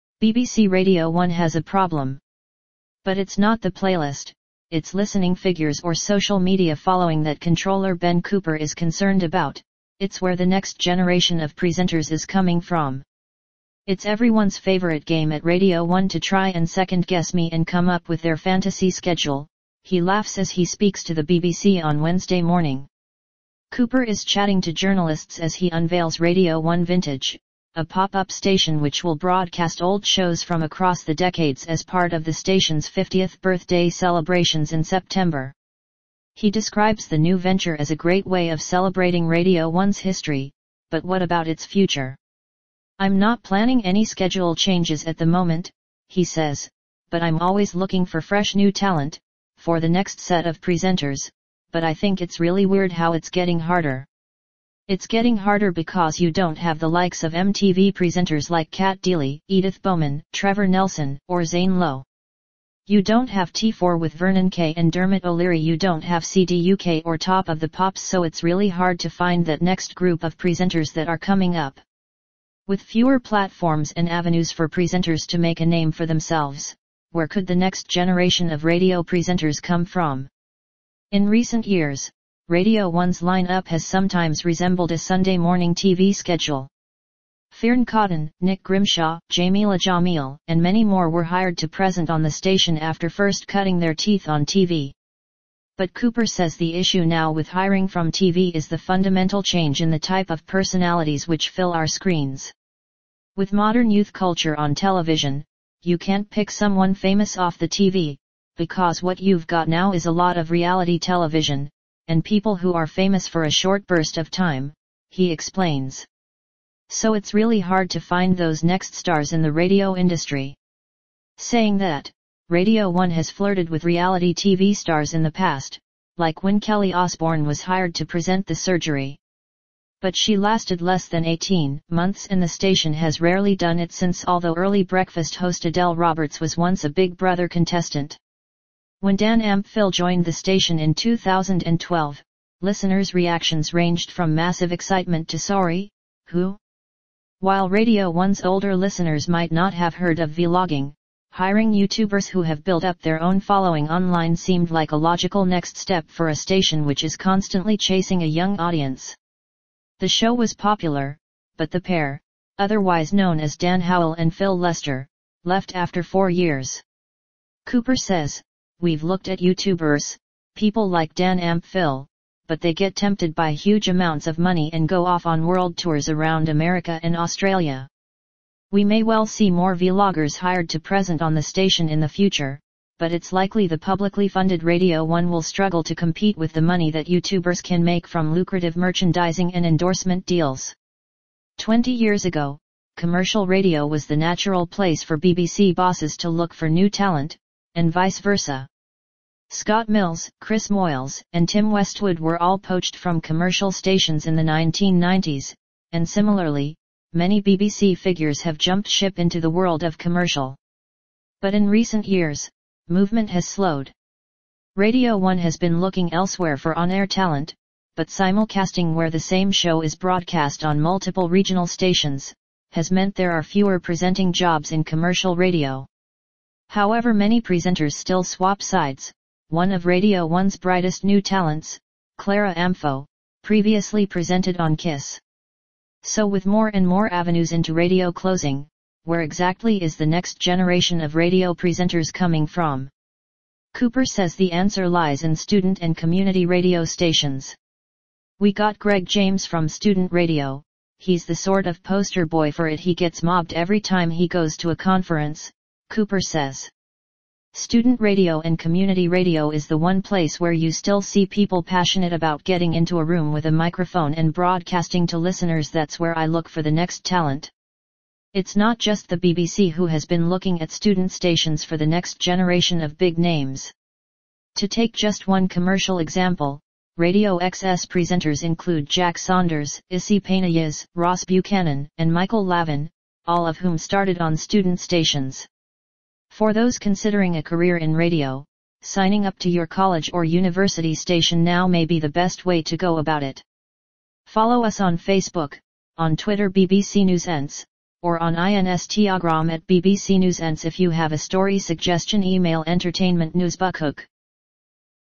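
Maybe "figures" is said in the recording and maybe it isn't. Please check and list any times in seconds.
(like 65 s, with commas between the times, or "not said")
5 s, 207 s.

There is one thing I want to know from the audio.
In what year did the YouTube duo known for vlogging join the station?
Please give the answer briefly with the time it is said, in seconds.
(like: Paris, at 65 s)
2012, at 140 s.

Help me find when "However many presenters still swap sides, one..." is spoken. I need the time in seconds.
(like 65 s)
226 s.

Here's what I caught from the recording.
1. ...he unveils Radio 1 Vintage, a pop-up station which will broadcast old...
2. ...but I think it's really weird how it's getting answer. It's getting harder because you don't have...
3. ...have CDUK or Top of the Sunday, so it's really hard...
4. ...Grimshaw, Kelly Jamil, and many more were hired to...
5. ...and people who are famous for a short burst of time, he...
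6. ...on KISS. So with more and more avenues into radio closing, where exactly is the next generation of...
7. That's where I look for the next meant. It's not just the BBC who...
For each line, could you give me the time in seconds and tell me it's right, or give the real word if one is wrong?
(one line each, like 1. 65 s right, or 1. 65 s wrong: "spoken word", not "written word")
1. 25 s right
2. 51 s wrong: "harder", not "answer"
3. 66 s wrong: "Pops", not "Sunday"
4. 88 s wrong: "Jameela", not "Kelly"
5. 112 s right
6. 234 s right
7. 265 s wrong: "talent", not "meant".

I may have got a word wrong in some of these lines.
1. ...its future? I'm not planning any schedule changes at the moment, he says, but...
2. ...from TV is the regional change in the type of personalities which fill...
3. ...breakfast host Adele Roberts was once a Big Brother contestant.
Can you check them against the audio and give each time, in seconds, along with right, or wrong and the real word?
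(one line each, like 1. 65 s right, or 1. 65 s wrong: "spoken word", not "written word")
1. 41 s right
2. 97 s wrong: "fundamental", not "regional"
3. 134 s right.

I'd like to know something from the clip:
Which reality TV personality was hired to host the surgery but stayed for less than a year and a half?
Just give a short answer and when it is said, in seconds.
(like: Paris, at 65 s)
Kelly Osbourne, at 126 s.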